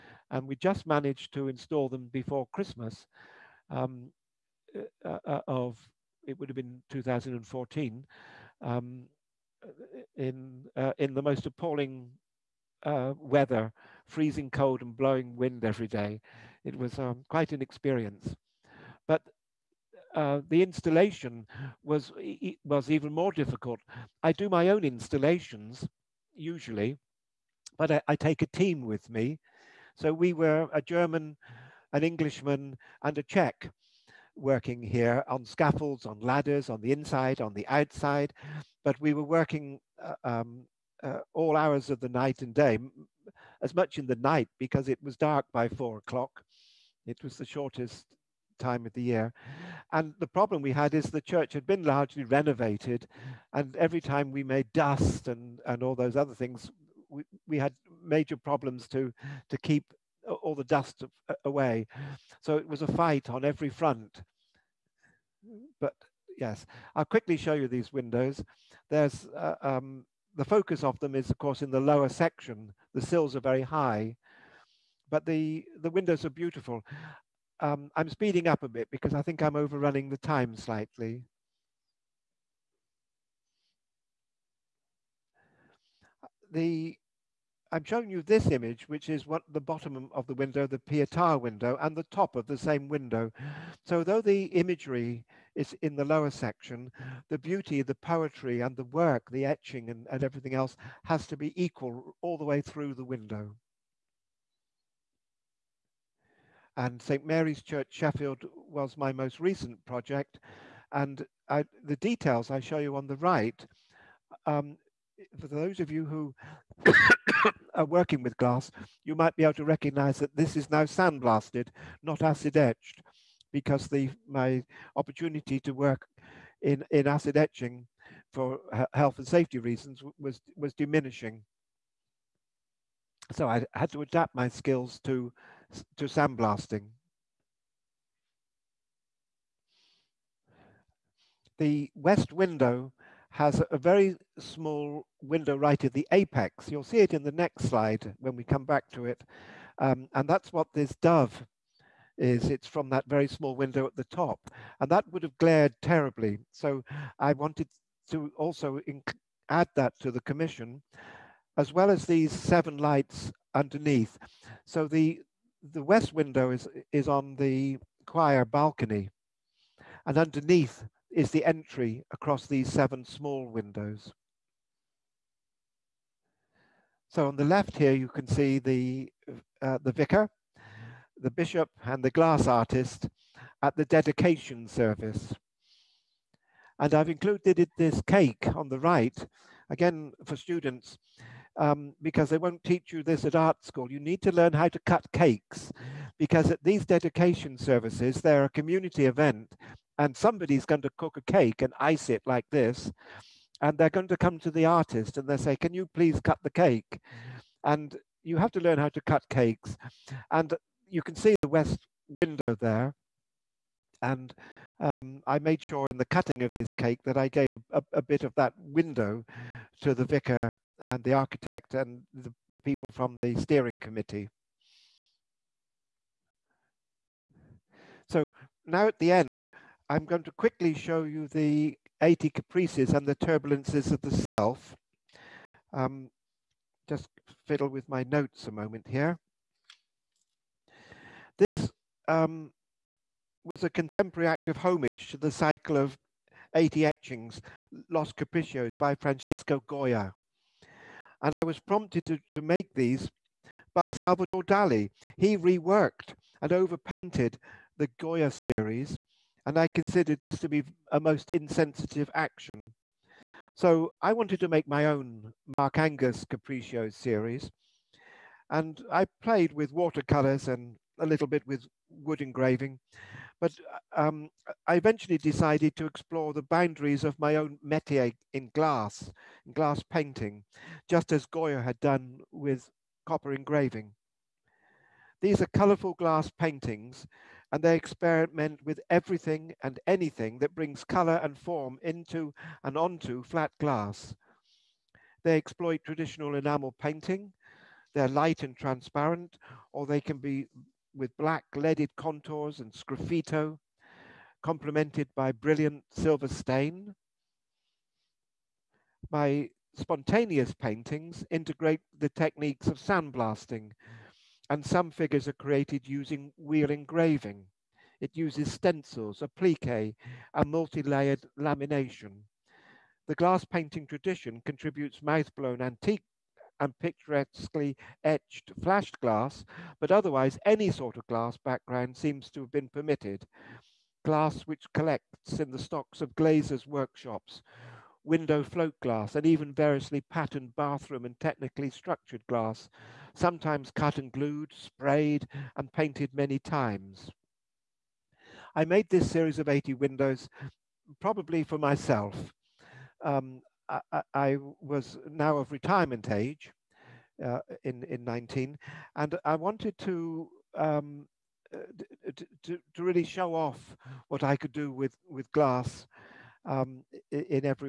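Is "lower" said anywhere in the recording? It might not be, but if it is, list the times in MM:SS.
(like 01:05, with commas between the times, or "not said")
01:11, 01:36.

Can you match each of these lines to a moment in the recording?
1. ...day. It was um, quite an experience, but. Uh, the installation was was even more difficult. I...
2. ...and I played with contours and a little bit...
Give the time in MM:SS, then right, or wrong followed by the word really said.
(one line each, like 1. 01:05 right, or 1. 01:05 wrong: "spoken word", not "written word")
1. 00:15 right
2. 04:28 wrong: "watercolors", not "contours".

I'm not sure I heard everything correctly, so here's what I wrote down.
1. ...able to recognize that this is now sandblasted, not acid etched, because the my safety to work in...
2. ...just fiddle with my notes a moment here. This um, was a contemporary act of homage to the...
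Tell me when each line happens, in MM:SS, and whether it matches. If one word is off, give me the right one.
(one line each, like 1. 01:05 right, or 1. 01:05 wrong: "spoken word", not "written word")
1. 01:59 wrong: "opportunity", not "safety"
2. 03:56 right.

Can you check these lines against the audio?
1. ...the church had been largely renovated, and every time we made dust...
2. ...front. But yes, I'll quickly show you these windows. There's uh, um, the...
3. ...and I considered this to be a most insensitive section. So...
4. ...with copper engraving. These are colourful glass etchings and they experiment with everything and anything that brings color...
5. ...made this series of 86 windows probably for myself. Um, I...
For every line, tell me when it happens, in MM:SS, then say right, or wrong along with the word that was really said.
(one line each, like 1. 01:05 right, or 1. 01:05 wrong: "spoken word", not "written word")
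1. 00:51 right
2. 01:03 right
3. 04:19 wrong: "action", not "section"
4. 04:42 wrong: "paintings", not "etchings"
5. 05:48 wrong: "80", not "86".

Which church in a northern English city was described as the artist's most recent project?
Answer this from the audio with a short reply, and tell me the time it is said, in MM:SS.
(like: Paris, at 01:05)
St. Mary's Church, Sheffield, at 01:47.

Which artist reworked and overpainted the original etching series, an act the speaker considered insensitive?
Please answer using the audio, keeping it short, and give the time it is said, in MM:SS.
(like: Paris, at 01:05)
Salvador Dali, at 04:13.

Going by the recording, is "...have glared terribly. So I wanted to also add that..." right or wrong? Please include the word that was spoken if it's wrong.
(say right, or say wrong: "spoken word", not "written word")
right.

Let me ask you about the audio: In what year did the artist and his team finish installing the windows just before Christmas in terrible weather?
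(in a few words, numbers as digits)
2014.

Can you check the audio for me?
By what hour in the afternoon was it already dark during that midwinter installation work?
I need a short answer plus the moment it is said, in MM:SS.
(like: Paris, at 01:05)
4 o'clock, at 00:45.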